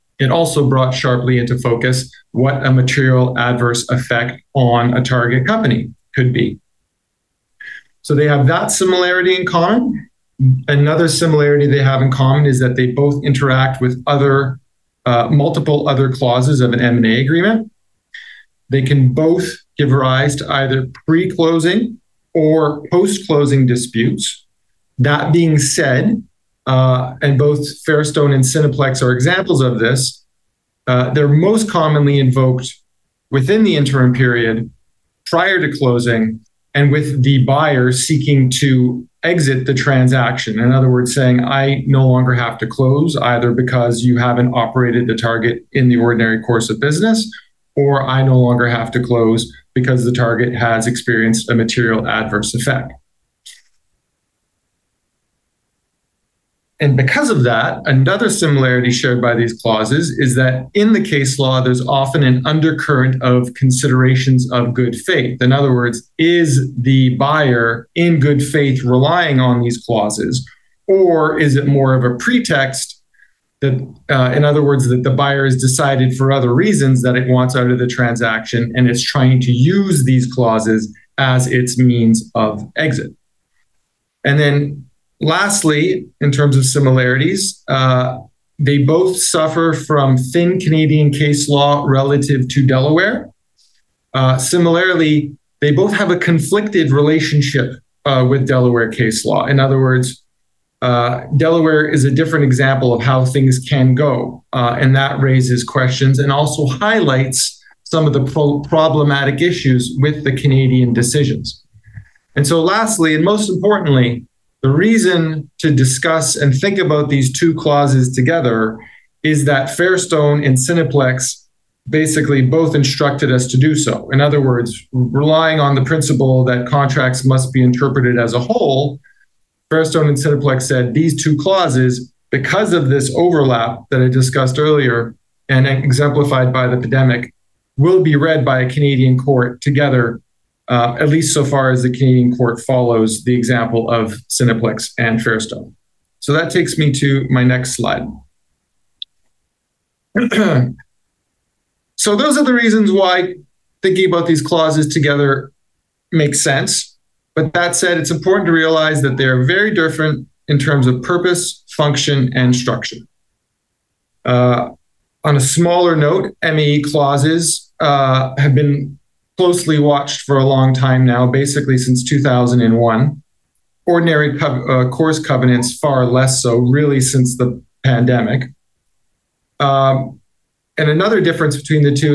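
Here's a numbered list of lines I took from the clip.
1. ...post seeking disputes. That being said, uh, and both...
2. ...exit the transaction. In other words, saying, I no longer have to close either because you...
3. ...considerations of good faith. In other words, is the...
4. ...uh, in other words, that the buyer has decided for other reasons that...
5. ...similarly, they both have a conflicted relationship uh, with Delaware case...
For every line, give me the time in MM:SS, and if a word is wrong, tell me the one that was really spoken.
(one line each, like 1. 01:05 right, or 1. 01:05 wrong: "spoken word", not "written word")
1. 00:22 wrong: "closing", not "seeking"
2. 00:39 right
3. 01:03 right
4. 01:14 right
5. 01:34 right.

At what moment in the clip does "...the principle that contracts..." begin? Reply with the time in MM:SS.
02:05.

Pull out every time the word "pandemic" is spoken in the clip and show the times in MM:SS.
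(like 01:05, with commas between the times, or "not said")
02:16, 02:57.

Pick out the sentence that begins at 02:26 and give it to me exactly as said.
So that takes me to my next slide.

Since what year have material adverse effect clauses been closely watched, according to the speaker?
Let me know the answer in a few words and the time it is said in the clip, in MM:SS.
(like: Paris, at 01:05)
2001, at 02:52.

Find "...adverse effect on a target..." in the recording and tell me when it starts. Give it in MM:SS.
00:03.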